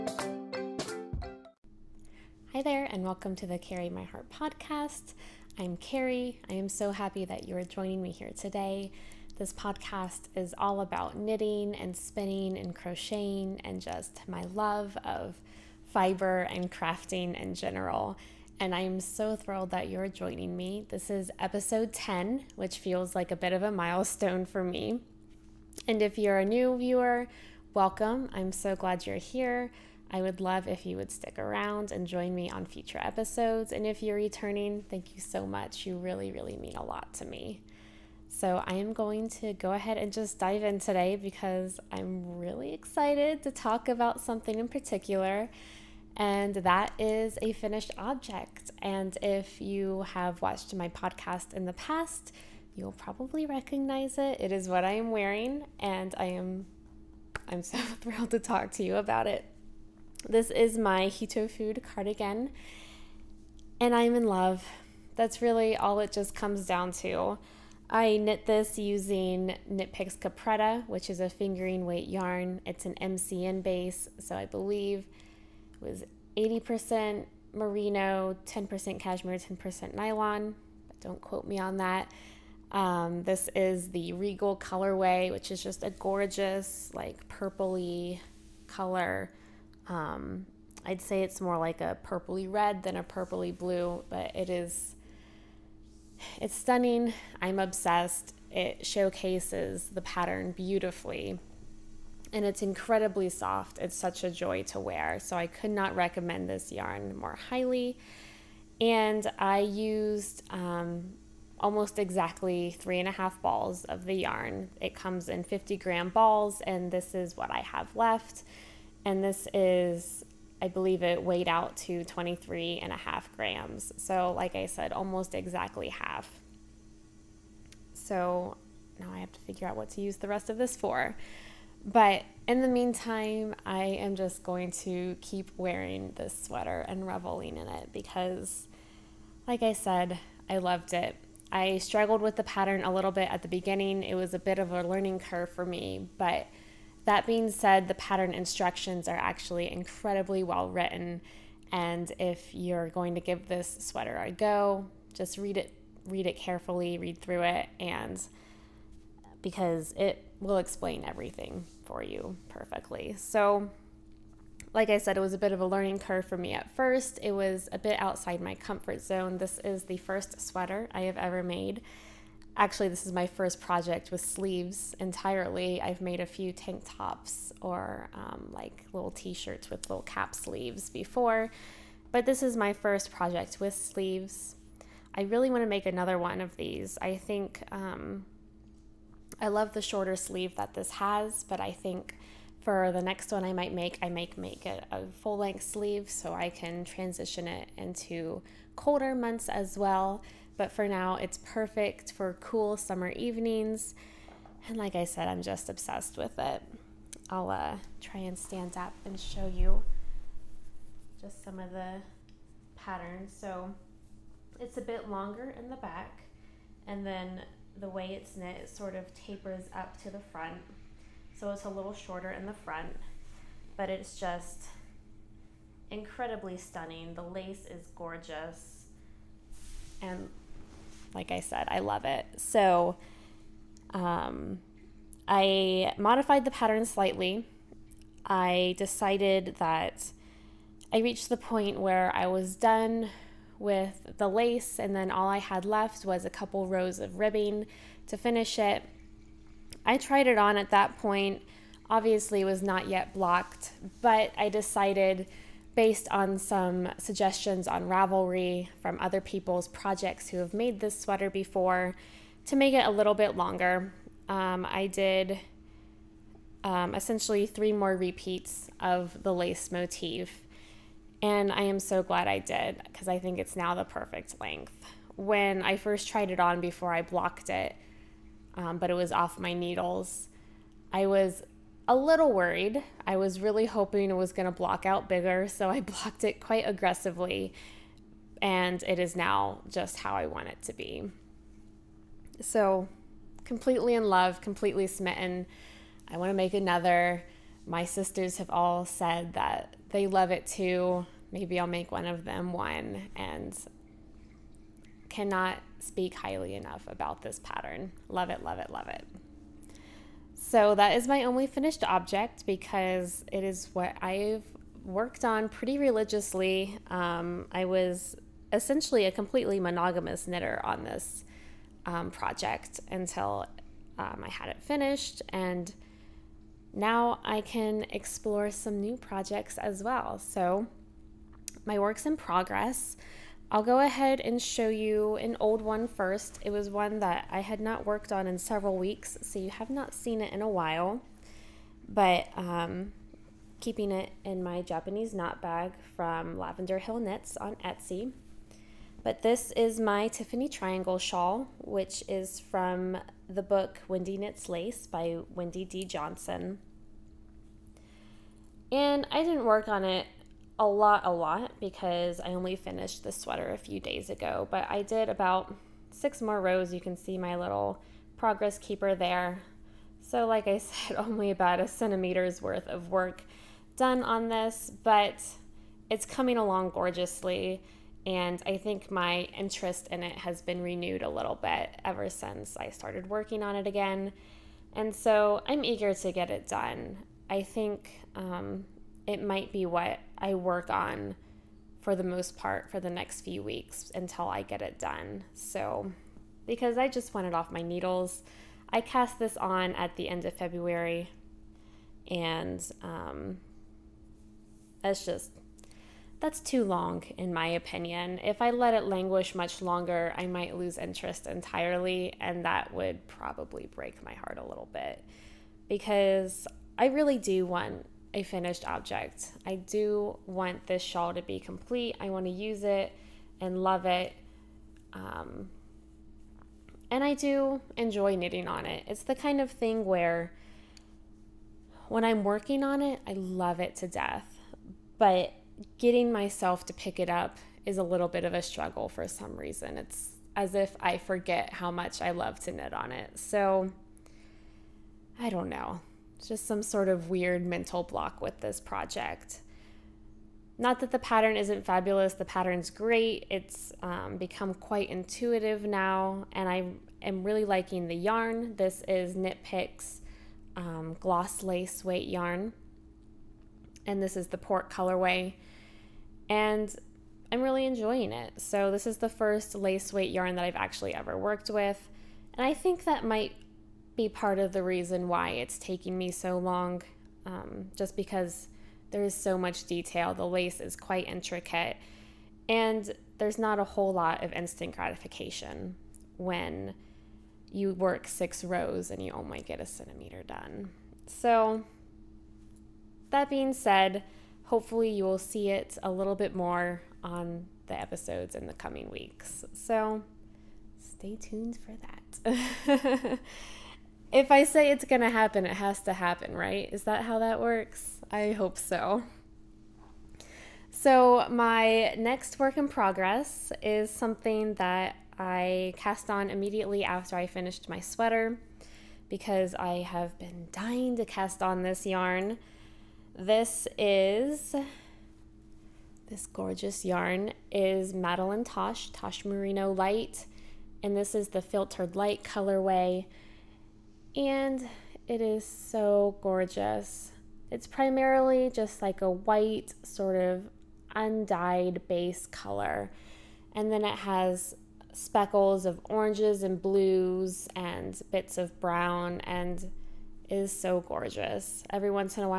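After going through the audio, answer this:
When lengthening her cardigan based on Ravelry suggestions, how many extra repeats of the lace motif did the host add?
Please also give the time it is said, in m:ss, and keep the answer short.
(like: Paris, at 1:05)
3, at 4:27.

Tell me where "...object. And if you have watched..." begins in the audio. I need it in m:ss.
0:47.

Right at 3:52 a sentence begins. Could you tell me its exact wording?
So um, I modified the pattern slightly.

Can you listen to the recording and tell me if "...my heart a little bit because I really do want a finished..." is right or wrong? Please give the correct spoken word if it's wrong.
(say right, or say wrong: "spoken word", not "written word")
right.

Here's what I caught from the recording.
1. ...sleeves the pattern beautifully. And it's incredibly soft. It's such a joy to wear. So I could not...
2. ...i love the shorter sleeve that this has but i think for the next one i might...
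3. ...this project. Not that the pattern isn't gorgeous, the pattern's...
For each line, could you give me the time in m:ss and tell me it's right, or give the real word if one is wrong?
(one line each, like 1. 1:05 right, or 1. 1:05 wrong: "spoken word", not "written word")
1. 1:38 wrong: "showcases", not "sleeves"
2. 3:09 right
3. 7:28 wrong: "fabulous", not "gorgeous".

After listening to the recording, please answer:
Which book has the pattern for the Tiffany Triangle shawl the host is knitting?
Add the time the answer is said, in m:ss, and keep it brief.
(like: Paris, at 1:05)
Wendy Knits Lace, at 5:53.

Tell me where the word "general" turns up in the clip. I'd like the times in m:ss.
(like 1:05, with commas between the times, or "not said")
0:17.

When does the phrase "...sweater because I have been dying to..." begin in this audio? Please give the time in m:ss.
8:37.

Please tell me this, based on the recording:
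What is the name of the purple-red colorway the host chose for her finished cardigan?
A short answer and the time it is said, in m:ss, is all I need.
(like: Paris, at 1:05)
Regal, at 1:24.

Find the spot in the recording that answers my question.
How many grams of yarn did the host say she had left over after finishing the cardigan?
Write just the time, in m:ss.
2:02.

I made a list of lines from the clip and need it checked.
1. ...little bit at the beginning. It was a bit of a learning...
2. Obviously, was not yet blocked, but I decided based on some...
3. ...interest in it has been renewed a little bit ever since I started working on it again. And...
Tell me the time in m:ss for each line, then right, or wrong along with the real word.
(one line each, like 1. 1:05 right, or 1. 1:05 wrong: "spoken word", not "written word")
1. 2:22 right
2. 4:11 right
3. 6:19 right.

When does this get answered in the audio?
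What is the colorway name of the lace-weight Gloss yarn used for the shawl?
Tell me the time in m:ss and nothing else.
7:44.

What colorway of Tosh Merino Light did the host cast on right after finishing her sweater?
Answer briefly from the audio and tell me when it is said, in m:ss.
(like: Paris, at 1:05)
Filtered Light, at 8:51.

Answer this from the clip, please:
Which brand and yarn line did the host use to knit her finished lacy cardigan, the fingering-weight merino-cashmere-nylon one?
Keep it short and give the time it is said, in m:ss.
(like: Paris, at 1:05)
Knit Picks Capretta, at 1:09.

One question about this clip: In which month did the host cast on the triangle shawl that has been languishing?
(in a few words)
February.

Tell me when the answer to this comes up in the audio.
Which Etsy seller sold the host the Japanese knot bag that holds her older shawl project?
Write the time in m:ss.
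5:46.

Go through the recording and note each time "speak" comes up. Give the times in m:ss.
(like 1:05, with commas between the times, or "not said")
5:05.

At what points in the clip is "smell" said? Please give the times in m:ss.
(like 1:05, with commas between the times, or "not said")
not said.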